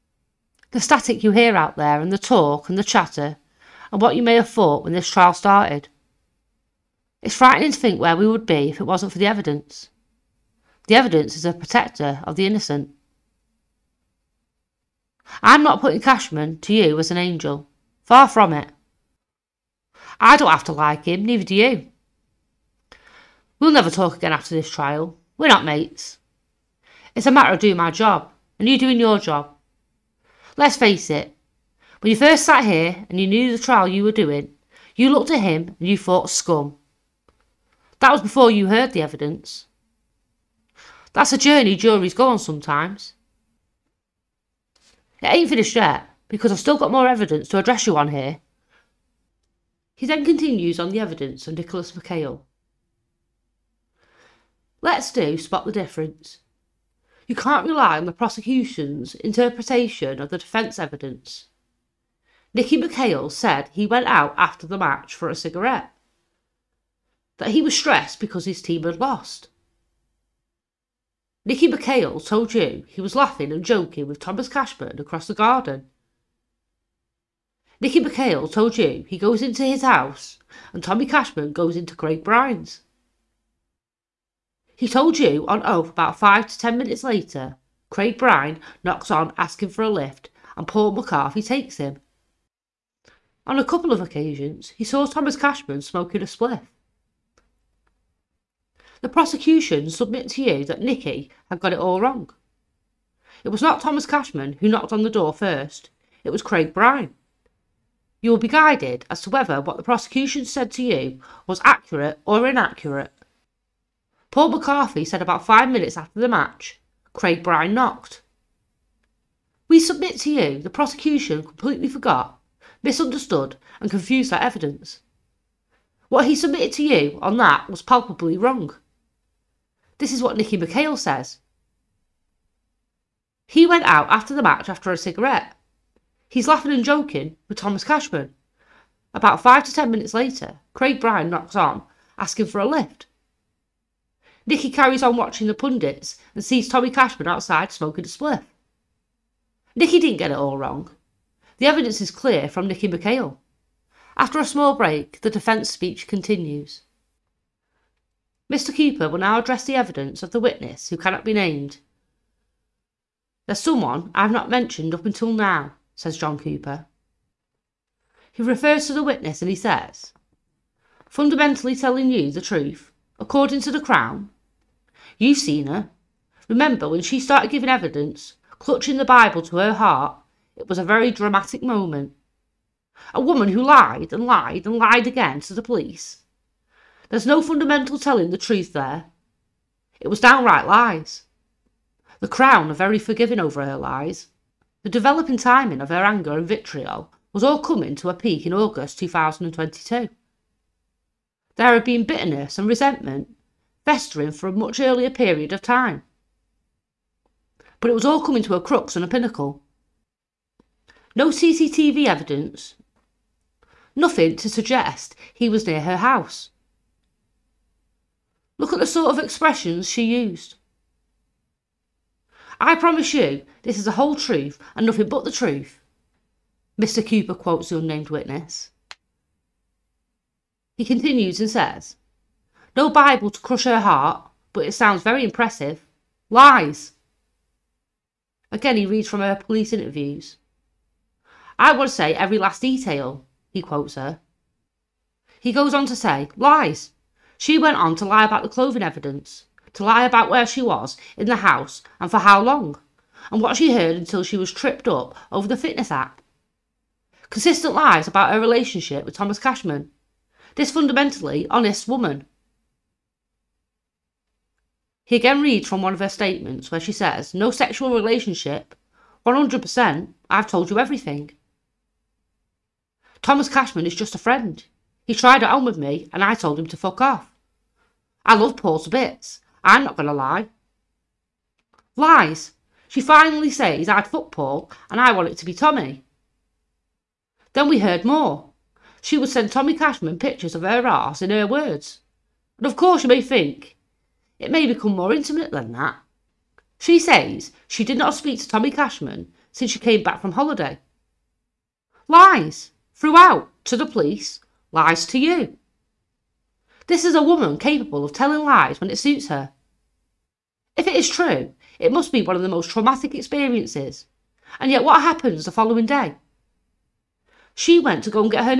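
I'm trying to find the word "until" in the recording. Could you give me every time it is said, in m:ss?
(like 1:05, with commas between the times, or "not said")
2:45, 4:13.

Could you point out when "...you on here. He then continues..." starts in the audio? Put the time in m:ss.
0:47.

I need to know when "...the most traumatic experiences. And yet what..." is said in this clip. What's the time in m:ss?
5:12.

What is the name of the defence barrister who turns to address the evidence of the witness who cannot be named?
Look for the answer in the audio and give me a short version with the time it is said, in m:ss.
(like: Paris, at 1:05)
John Cooper, at 2:46.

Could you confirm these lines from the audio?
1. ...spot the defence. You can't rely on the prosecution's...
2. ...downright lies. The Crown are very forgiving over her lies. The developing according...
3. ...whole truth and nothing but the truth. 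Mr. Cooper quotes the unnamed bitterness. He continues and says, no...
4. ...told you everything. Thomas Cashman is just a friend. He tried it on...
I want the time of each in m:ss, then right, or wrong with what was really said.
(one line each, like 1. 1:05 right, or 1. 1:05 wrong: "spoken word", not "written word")
1. 0:55 wrong: "difference", not "defence"
2. 3:10 wrong: "timing", not "according"
3. 3:43 wrong: "witness", not "bitterness"
4. 4:30 right.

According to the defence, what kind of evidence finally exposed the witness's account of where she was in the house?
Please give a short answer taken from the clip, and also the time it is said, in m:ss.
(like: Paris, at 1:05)
fitness app, at 4:15.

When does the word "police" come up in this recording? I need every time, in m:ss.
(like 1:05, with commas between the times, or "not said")
3:05, 3:59, 5:03.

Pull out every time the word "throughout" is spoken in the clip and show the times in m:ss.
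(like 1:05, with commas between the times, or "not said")
5:02.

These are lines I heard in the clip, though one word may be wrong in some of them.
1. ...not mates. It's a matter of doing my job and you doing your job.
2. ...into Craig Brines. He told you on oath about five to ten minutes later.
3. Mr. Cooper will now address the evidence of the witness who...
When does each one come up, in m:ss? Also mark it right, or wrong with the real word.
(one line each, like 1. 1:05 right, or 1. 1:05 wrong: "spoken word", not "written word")
1. 0:25 right
2. 1:21 right
3. 2:38 right.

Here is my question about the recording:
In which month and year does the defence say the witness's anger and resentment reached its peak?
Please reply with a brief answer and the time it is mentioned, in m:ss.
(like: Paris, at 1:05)
August 2022, at 3:18.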